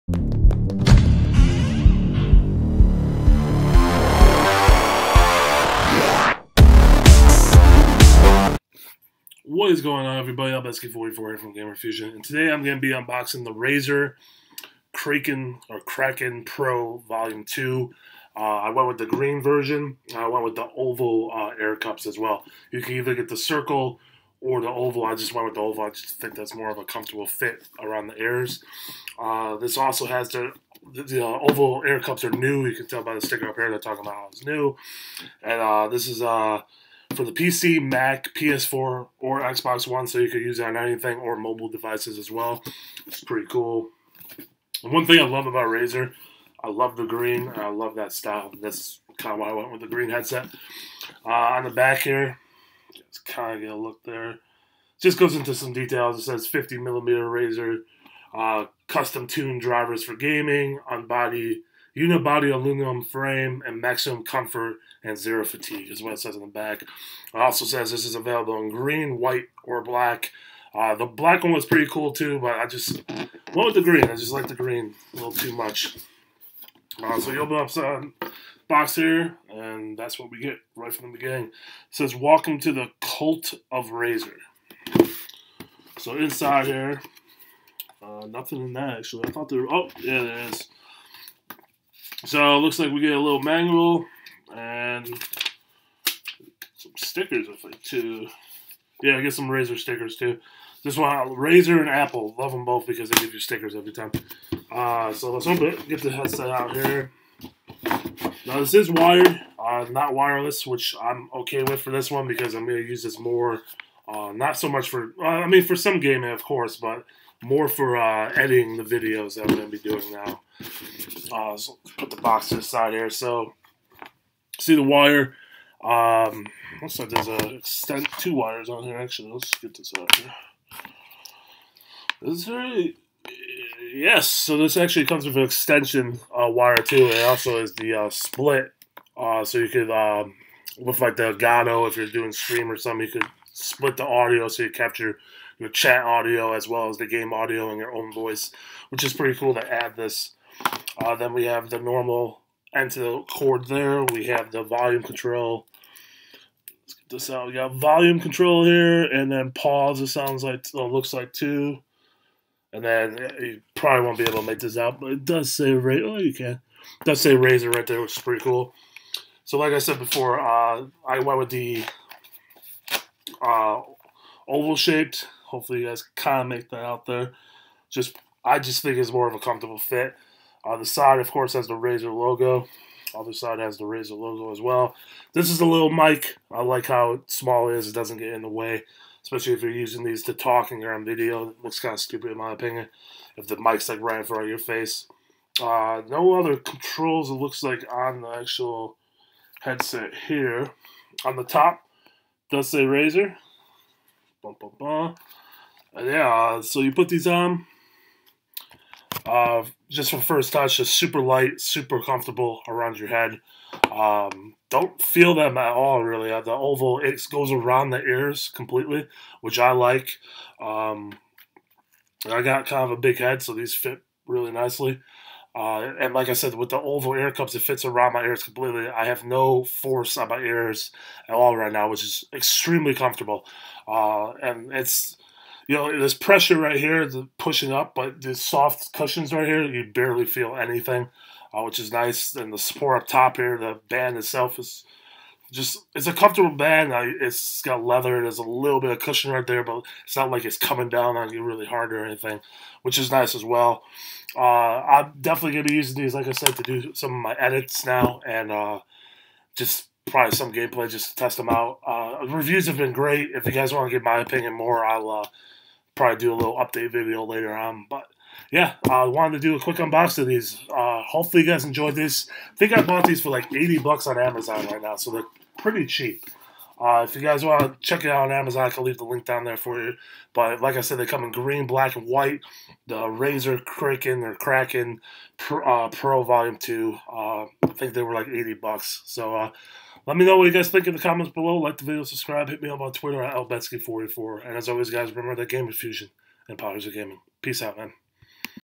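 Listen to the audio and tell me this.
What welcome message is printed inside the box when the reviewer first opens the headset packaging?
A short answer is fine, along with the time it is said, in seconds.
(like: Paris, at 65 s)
Welcome to the Cult of Razer, at 82 s.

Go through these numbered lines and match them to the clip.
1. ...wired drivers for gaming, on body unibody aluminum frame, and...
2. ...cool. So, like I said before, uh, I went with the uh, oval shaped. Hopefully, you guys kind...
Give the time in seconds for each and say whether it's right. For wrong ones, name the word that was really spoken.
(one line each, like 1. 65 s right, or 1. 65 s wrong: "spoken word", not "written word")
1. 59 s wrong: "tuned", not "wired"
2. 168 s right.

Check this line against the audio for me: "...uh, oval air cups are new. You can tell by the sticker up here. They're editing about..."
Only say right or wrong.
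wrong.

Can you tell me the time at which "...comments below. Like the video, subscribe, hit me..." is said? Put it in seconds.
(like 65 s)
291 s.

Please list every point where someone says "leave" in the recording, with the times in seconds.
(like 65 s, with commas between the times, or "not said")
278 s.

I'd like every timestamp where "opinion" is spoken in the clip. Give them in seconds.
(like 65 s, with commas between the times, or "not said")
192 s, 264 s.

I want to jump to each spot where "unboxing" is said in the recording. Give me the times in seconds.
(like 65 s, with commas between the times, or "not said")
12 s, 269 s.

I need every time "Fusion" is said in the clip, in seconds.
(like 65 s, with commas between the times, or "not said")
11 s, 295 s.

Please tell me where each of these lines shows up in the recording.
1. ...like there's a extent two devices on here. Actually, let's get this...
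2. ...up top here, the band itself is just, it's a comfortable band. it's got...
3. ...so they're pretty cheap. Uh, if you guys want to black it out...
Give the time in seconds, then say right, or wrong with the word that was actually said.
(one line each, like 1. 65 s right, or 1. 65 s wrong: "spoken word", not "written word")
1. 126 s wrong: "wires", not "devices"
2. 243 s right
3. 274 s wrong: "check", not "black".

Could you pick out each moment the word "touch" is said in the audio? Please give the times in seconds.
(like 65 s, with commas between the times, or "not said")
210 s.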